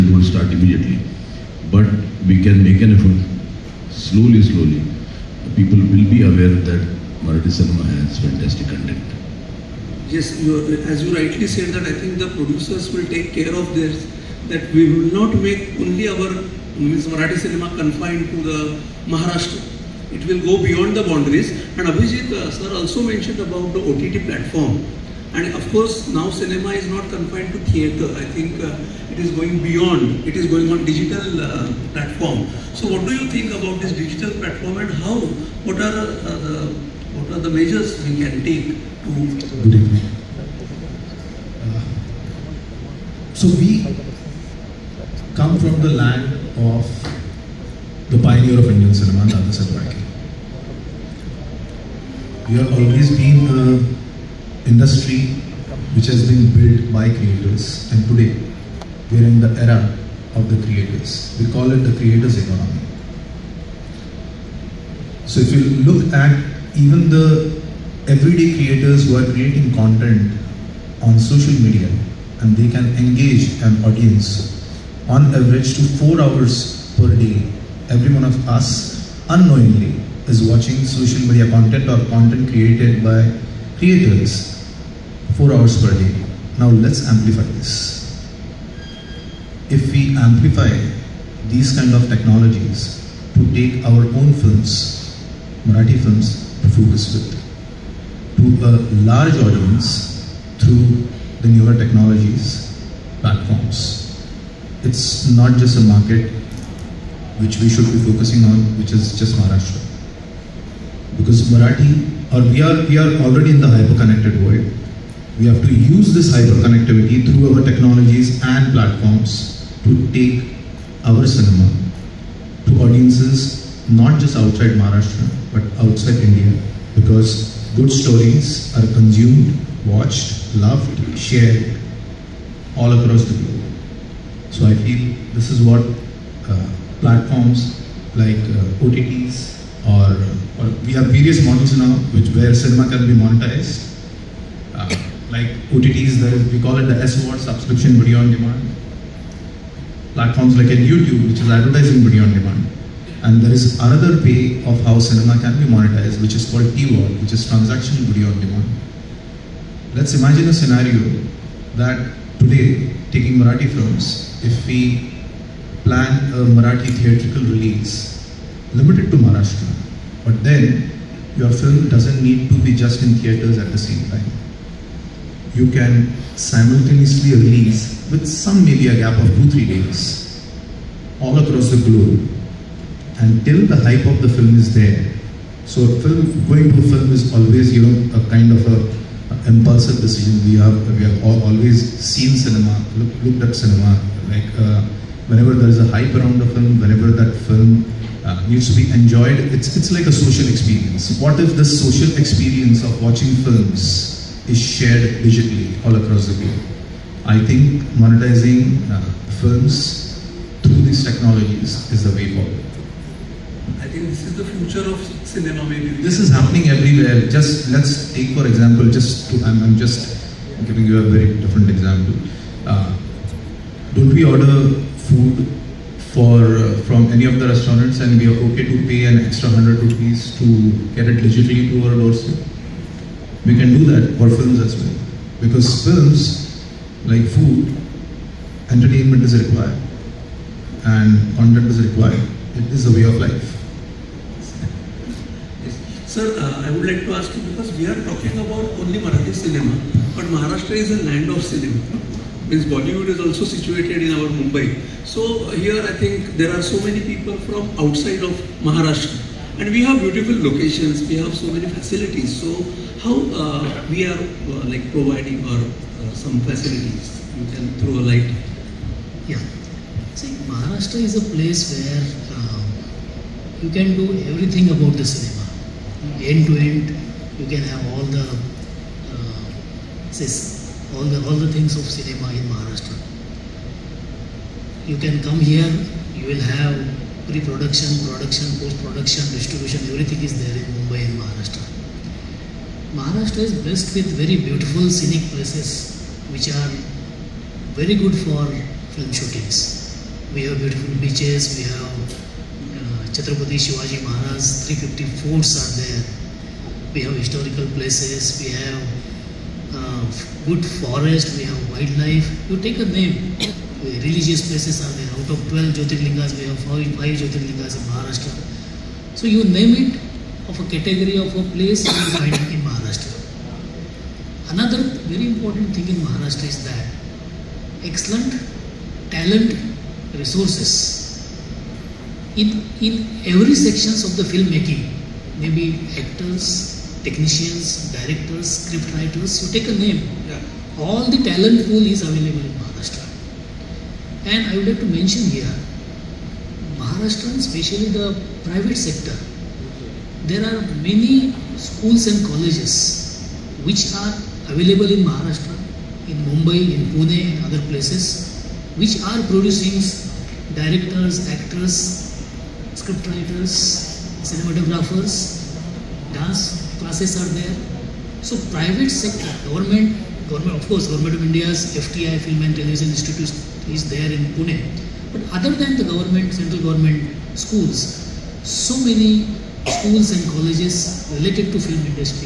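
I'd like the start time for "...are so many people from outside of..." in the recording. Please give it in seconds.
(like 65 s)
256 s.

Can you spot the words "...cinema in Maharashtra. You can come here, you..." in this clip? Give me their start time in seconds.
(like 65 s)
281 s.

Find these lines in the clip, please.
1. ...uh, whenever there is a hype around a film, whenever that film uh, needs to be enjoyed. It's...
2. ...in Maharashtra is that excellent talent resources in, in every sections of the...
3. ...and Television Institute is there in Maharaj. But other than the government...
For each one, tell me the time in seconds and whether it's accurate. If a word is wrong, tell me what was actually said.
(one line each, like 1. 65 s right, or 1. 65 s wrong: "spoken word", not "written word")
1. 194 s right
2. 325 s right
3. 372 s wrong: "Pune", not "Maharaj".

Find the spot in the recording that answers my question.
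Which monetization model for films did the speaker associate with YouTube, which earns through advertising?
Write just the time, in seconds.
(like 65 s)
151 s.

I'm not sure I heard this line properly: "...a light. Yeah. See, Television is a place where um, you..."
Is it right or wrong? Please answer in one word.
wrong.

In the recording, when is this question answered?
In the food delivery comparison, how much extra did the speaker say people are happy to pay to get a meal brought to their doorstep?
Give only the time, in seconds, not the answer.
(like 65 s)
229 s.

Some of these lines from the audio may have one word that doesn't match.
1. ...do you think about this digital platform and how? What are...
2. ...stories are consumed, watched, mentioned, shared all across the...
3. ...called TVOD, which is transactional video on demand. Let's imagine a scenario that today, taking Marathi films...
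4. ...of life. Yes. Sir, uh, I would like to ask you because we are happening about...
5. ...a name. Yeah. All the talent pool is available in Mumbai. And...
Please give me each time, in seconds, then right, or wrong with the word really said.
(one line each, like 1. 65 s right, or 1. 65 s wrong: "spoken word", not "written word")
1. 33 s right
2. 127 s wrong: "loved", not "mentioned"
3. 156 s right
4. 243 s wrong: "talking", not "happening"
5. 339 s wrong: "Maharashtra", not "Mumbai".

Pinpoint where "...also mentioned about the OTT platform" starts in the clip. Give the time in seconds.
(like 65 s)
22 s.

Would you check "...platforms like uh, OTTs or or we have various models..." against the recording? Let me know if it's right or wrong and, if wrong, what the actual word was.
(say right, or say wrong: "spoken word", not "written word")
right.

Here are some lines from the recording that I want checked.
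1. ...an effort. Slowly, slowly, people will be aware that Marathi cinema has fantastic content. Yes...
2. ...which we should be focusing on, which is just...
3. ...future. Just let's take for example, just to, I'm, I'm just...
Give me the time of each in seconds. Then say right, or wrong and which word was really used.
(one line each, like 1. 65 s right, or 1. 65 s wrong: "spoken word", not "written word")
1. 2 s right
2. 107 s right
3. 216 s wrong: "everywhere", not "future".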